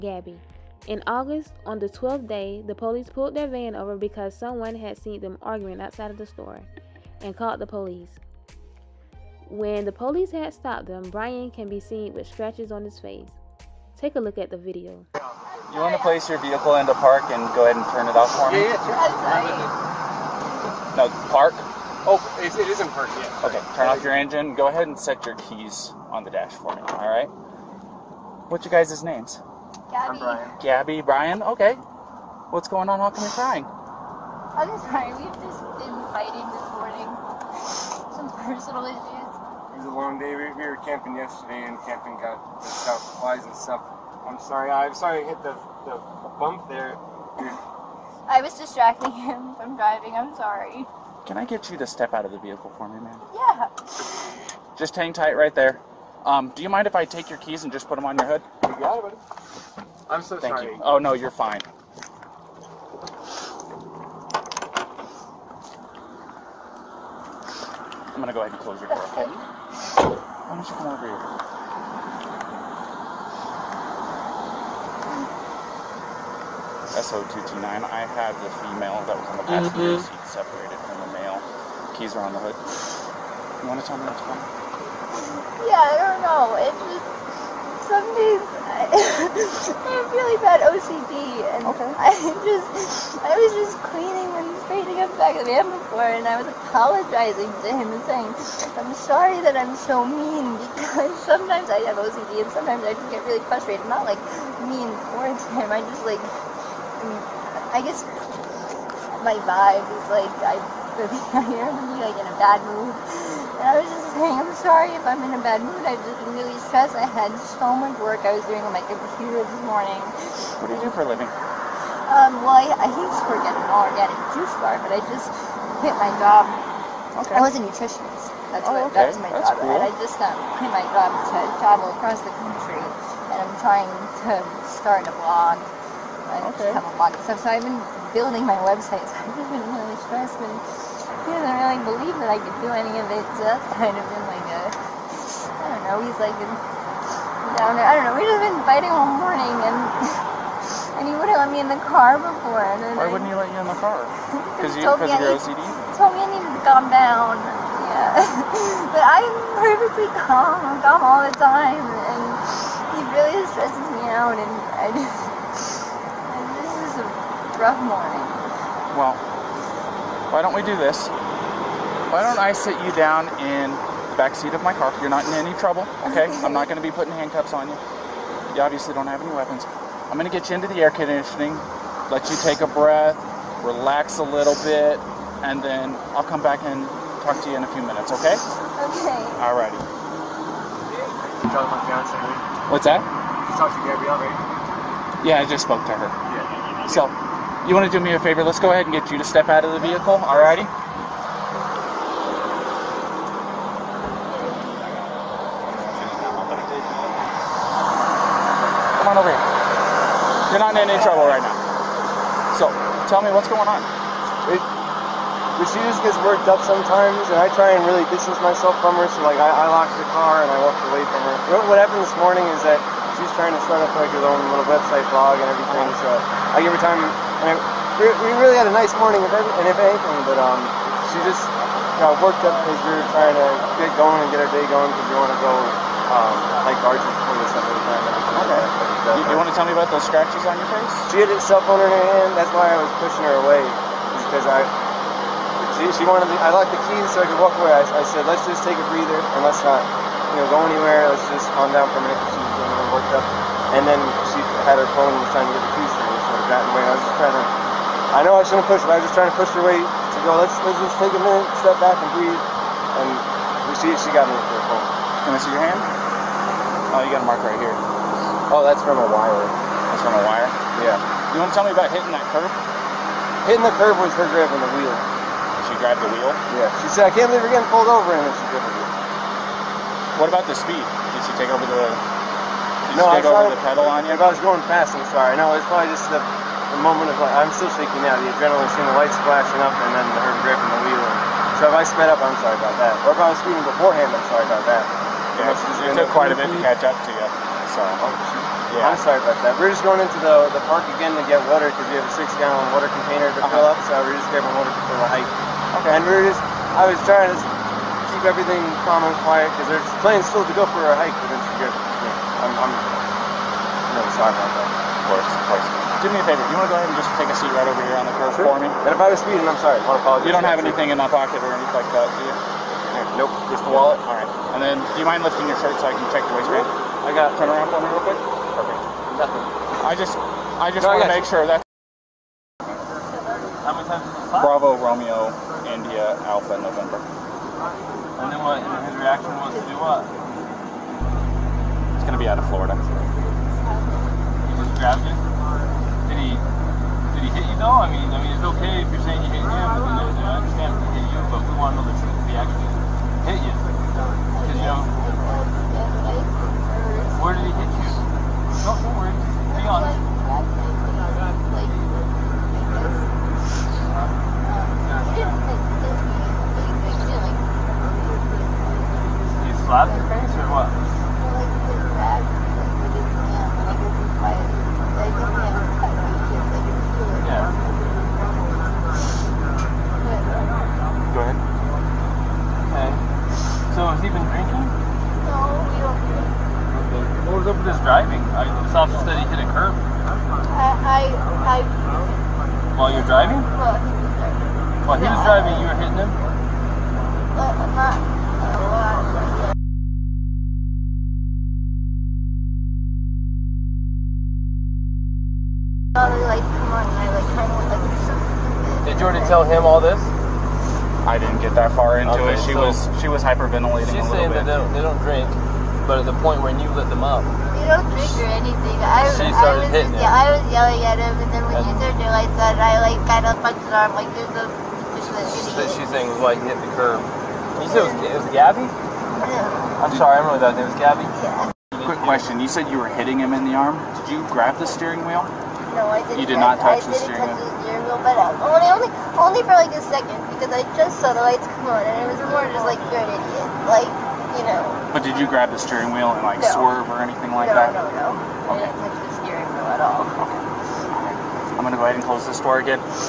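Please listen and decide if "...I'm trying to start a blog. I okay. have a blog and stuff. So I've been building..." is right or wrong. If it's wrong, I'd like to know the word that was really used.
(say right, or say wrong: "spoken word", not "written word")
right.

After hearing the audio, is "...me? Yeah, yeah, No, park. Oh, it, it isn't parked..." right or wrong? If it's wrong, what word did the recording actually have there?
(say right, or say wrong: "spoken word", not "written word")
right.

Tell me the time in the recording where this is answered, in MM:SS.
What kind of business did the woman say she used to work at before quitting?
02:03.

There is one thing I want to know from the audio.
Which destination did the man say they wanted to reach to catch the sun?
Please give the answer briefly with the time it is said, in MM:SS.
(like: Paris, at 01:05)
Arches, at 03:56.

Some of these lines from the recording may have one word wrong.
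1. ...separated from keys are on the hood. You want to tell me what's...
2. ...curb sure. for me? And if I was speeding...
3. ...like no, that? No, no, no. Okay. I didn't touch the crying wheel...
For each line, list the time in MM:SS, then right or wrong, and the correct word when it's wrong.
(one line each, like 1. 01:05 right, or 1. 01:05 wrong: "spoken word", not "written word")
1. 01:20 right
2. 05:18 right
3. 07:27 wrong: "steering", not "crying".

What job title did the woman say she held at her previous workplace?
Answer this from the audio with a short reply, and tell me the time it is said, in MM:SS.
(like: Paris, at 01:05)
nutritionist, at 02:07.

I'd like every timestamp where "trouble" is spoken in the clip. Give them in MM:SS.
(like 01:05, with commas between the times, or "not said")
02:55, 03:31.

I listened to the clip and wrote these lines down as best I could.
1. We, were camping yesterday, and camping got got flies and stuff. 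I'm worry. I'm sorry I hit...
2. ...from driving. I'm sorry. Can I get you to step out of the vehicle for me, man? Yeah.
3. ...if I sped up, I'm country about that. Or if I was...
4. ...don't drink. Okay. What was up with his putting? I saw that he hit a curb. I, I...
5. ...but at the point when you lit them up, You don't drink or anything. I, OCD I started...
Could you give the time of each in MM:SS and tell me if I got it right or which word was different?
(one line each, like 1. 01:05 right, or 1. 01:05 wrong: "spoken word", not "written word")
1. 00:40 wrong: "sorry", not "worry"
2. 00:49 right
3. 04:51 wrong: "sorry", not "country"
4. 06:25 wrong: "driving", not "putting"
5. 06:55 wrong: "She", not "OCD".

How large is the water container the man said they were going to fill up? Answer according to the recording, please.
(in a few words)
6 gallon.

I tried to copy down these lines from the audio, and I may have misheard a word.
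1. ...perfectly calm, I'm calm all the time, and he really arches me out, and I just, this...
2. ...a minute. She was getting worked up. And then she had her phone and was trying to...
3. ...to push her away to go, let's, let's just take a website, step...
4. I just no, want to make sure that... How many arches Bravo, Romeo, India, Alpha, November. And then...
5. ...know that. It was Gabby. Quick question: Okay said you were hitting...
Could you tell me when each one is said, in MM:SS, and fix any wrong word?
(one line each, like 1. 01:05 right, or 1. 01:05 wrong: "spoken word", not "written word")
1. 02:39 wrong: "stresses", not "arches"
2. 04:11 right
3. 04:19 wrong: "minute", not "website"
4. 05:30 wrong: "times", not "arches"
5. 07:10 wrong: "You", not "Okay".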